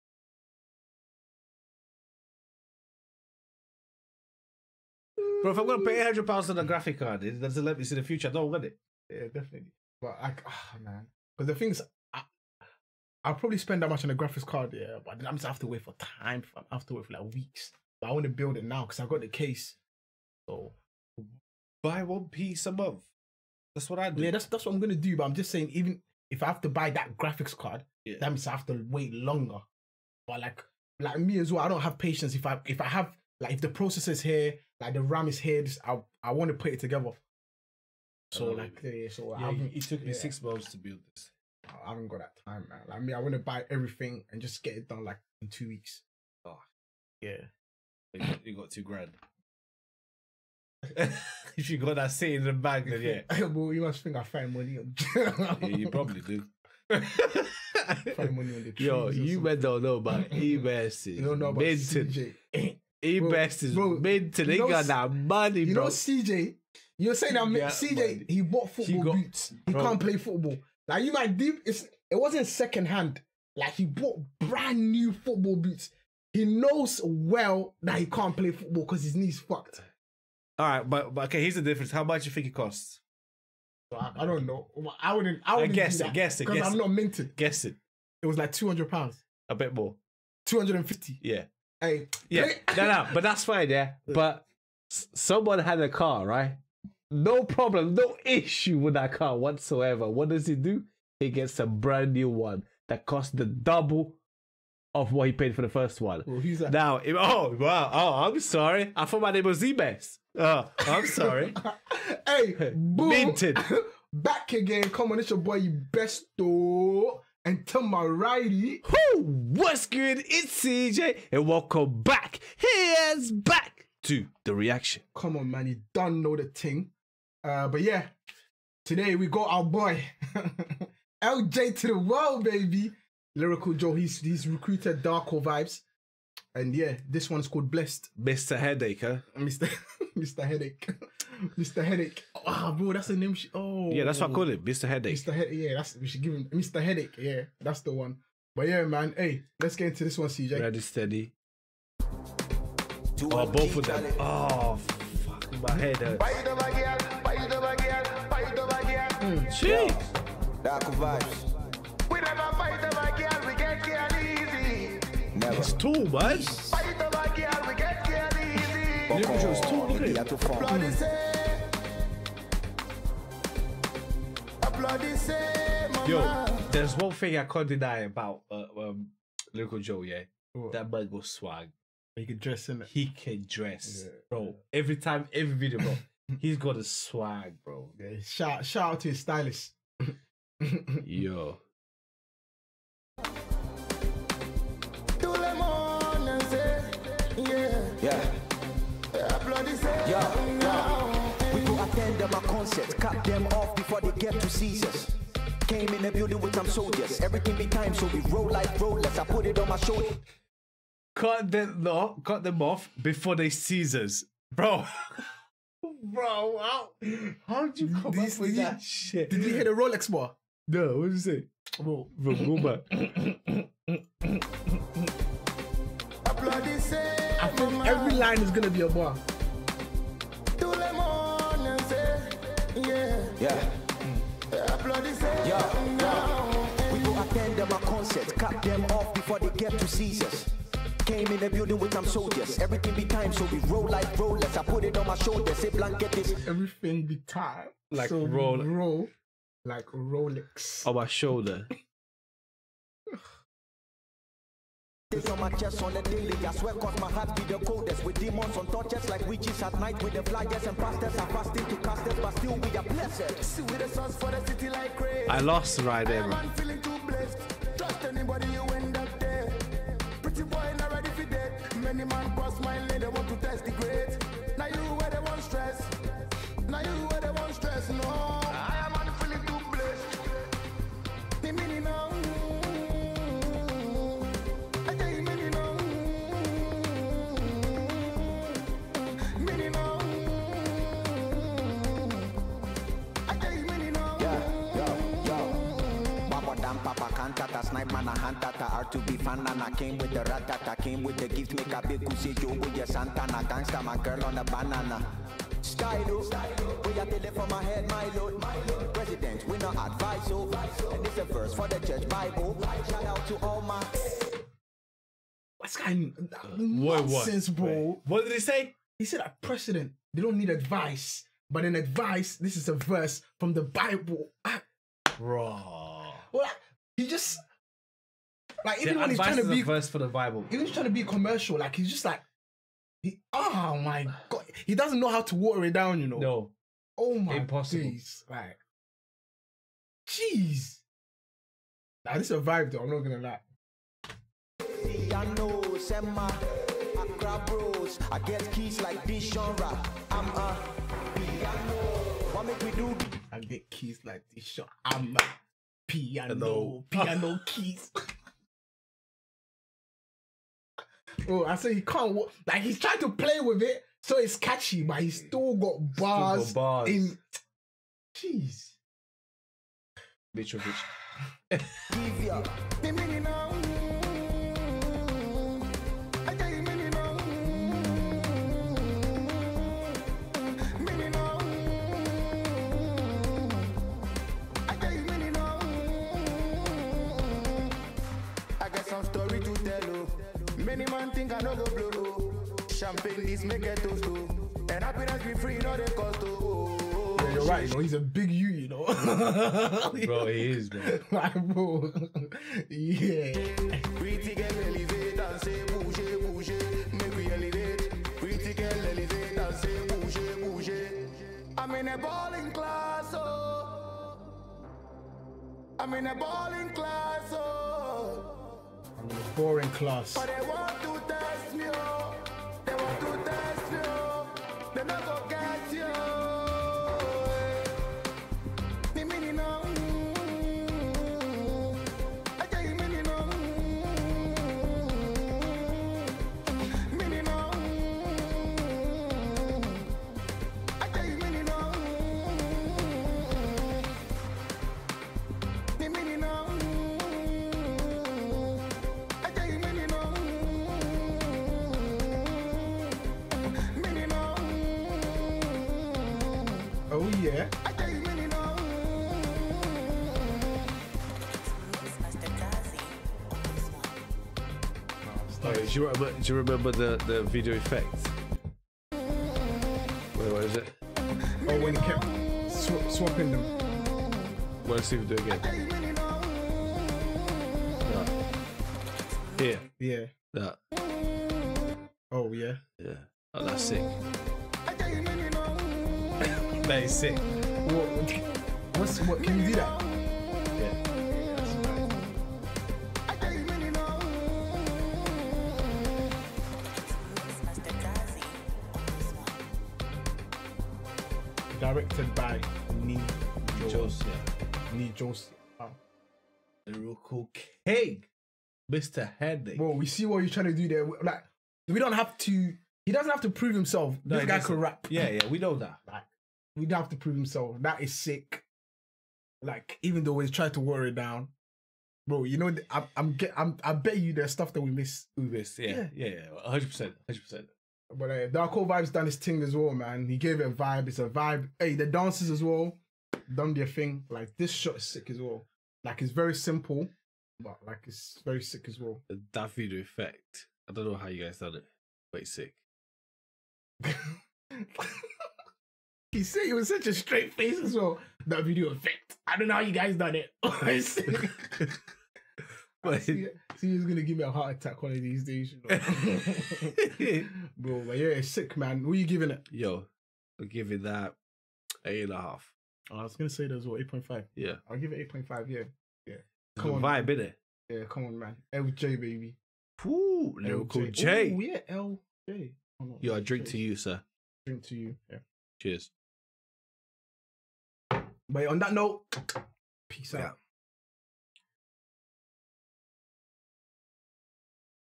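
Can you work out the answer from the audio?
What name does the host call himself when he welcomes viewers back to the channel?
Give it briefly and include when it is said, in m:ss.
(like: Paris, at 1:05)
Besto, at 1:55.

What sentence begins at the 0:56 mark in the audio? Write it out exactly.
Find money on the Yo, you men don't know about e You don't know about Benton.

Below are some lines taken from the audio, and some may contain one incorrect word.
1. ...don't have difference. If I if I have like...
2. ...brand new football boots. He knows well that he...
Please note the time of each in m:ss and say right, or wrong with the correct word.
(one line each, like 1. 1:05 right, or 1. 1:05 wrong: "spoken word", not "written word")
1. 0:31 wrong: "patience", not "difference"
2. 1:14 right.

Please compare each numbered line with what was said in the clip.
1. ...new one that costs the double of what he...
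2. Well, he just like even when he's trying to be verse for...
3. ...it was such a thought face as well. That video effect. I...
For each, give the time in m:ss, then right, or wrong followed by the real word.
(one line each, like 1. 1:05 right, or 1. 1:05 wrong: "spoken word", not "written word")
1. 1:42 right
2. 5:26 right
3. 9:06 wrong: "straight", not "thought".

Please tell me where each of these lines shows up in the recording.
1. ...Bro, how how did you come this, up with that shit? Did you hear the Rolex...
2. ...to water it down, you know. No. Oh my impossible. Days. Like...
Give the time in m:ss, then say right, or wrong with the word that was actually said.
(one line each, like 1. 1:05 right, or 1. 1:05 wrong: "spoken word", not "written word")
1. 3:36 right
2. 5:35 right.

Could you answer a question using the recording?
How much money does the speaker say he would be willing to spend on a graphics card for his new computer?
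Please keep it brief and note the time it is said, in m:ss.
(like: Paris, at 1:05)
800 pounds, at 0:06.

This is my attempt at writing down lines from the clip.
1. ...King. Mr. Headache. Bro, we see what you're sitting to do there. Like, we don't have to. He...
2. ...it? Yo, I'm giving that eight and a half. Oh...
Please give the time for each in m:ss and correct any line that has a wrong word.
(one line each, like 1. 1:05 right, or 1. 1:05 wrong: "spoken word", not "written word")
1. 8:27 wrong: "trying", not "sitting"
2. 9:19 right.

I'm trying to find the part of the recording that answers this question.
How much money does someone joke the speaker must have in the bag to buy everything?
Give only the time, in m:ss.
0:48.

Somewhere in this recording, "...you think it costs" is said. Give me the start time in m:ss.
1:22.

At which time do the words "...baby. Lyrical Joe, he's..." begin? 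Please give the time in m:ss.
2:12.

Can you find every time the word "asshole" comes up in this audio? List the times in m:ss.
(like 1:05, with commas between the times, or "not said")
not said.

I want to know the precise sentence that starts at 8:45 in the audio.
We miss, yeah, yeah, hundred percent, hundred percent.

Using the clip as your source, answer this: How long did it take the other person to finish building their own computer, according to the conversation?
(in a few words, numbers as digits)
6 months.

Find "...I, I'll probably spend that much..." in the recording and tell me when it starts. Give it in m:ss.
0:12.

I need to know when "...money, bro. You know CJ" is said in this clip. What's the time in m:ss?
1:05.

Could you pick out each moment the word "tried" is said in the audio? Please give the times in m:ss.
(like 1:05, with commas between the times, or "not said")
8:40.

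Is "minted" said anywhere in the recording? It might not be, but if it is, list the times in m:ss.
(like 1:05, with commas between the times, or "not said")
1:26, 1:53.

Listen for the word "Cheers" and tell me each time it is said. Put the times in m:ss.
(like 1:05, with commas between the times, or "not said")
9:35.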